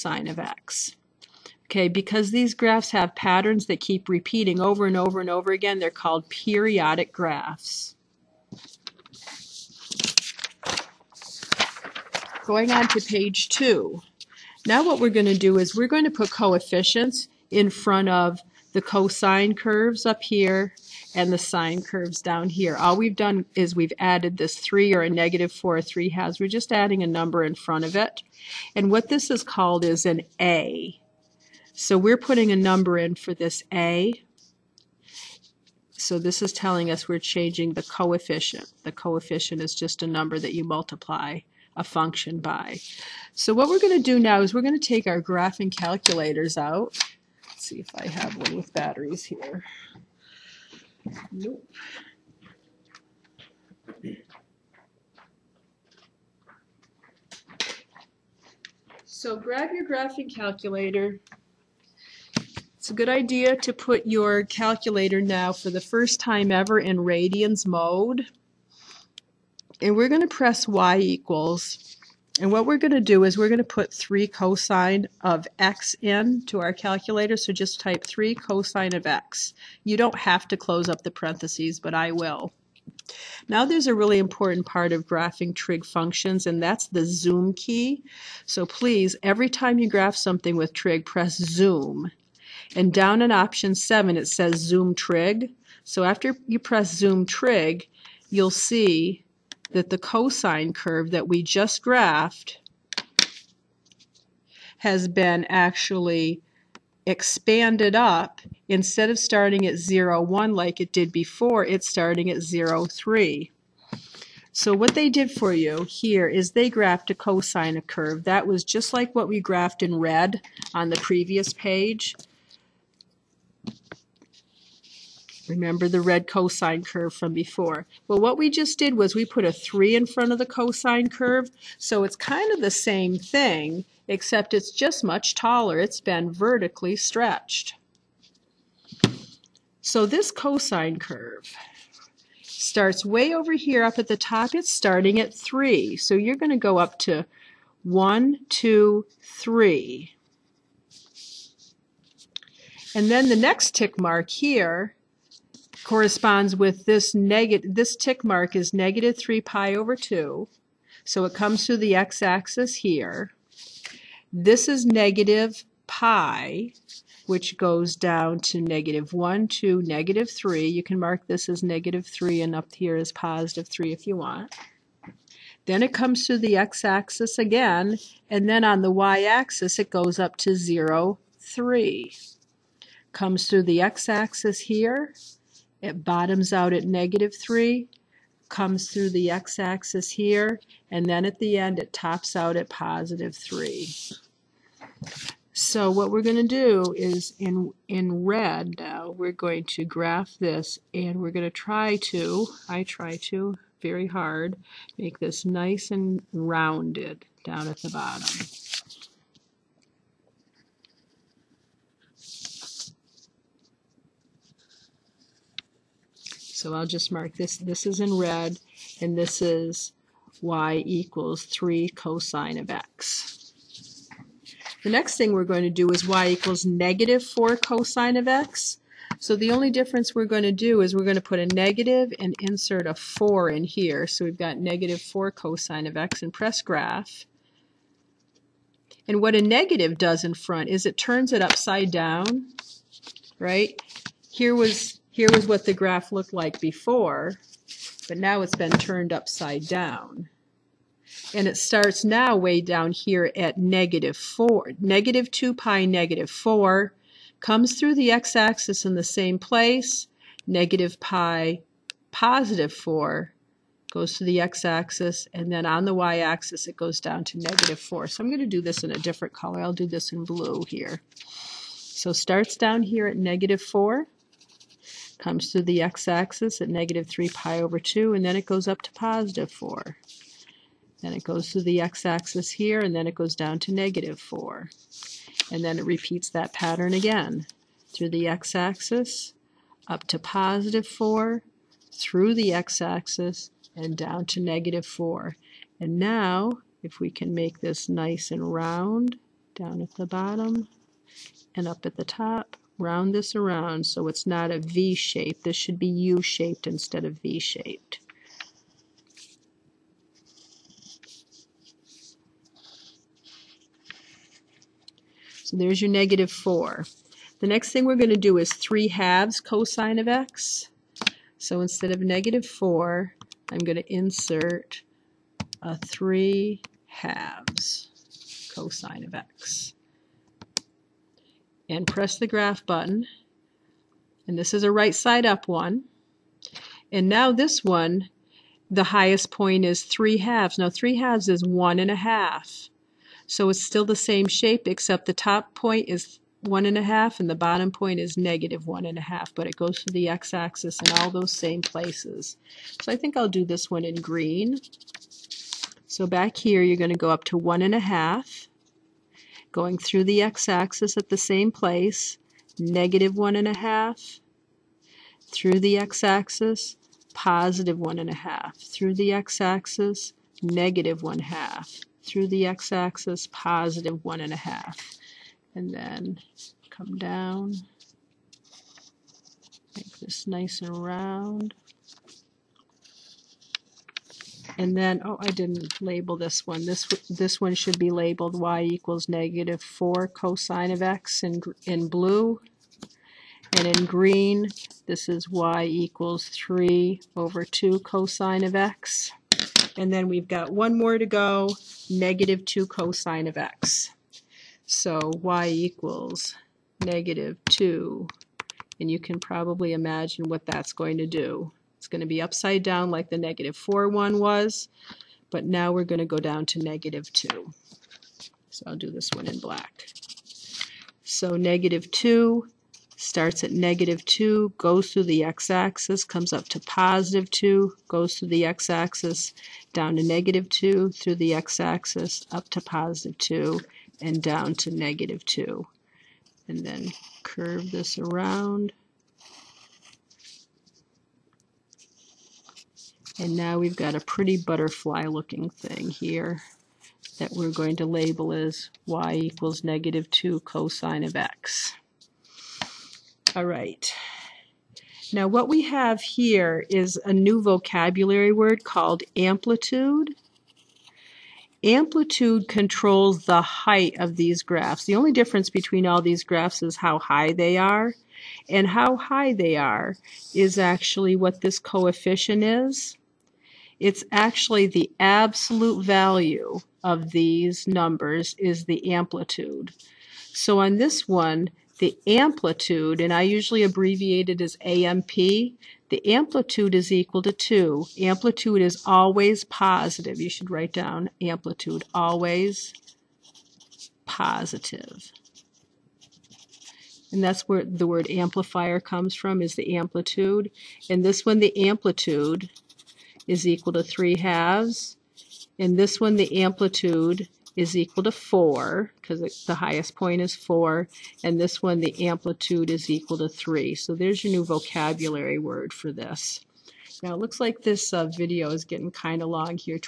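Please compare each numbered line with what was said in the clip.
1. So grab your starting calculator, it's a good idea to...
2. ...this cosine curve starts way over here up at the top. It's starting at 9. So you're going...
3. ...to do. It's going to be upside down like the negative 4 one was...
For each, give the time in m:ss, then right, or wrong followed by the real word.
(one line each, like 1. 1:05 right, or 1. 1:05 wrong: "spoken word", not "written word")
1. 0:59 wrong: "graphing", not "starting"
2. 2:20 wrong: "3", not "9"
3. 6:50 right.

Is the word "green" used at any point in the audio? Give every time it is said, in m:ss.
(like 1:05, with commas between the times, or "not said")
5:53, 6:33.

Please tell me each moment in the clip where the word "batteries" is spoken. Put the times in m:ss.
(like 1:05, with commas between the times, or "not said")
0:48.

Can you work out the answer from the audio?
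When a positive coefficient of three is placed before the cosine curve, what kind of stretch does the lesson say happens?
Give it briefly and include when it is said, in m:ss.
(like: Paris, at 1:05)
vertically stretched, at 2:16.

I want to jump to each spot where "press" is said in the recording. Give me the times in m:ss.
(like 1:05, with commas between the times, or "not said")
1:10, 1:31, 1:36, 3:56, 5:31.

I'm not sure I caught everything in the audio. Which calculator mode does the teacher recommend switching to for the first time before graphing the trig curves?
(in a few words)
radians.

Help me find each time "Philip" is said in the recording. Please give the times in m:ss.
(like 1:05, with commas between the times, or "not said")
not said.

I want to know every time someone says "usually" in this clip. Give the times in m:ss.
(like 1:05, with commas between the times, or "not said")
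8:03.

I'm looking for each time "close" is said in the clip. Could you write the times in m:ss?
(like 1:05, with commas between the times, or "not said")
1:20.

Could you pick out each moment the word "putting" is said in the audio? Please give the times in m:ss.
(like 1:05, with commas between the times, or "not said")
0:32.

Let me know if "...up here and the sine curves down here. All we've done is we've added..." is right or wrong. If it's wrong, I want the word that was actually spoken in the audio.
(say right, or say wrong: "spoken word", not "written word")
right.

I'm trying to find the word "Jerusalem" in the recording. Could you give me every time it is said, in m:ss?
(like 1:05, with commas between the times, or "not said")
not said.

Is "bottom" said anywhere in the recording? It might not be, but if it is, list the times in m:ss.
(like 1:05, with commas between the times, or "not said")
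3:06, 3:27, 5:00, 5:47.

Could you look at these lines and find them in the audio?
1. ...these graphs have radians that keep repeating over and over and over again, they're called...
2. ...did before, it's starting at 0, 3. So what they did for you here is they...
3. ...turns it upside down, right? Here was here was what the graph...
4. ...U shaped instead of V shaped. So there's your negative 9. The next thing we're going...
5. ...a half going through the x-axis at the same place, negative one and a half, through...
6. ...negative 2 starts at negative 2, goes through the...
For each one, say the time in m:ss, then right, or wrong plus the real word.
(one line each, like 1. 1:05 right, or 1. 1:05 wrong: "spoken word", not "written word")
1. 0:02 wrong: "patterns", not "radians"
2. 1:50 right
3. 4:00 right
4. 5:05 wrong: "4", not "9"
5. 5:57 right
6. 7:01 right.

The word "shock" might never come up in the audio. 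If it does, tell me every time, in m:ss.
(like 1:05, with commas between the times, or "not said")
not said.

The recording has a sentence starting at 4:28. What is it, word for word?
So I'm going to do this in a different color.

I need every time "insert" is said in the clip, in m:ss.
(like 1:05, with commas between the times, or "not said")
3:52, 5:23.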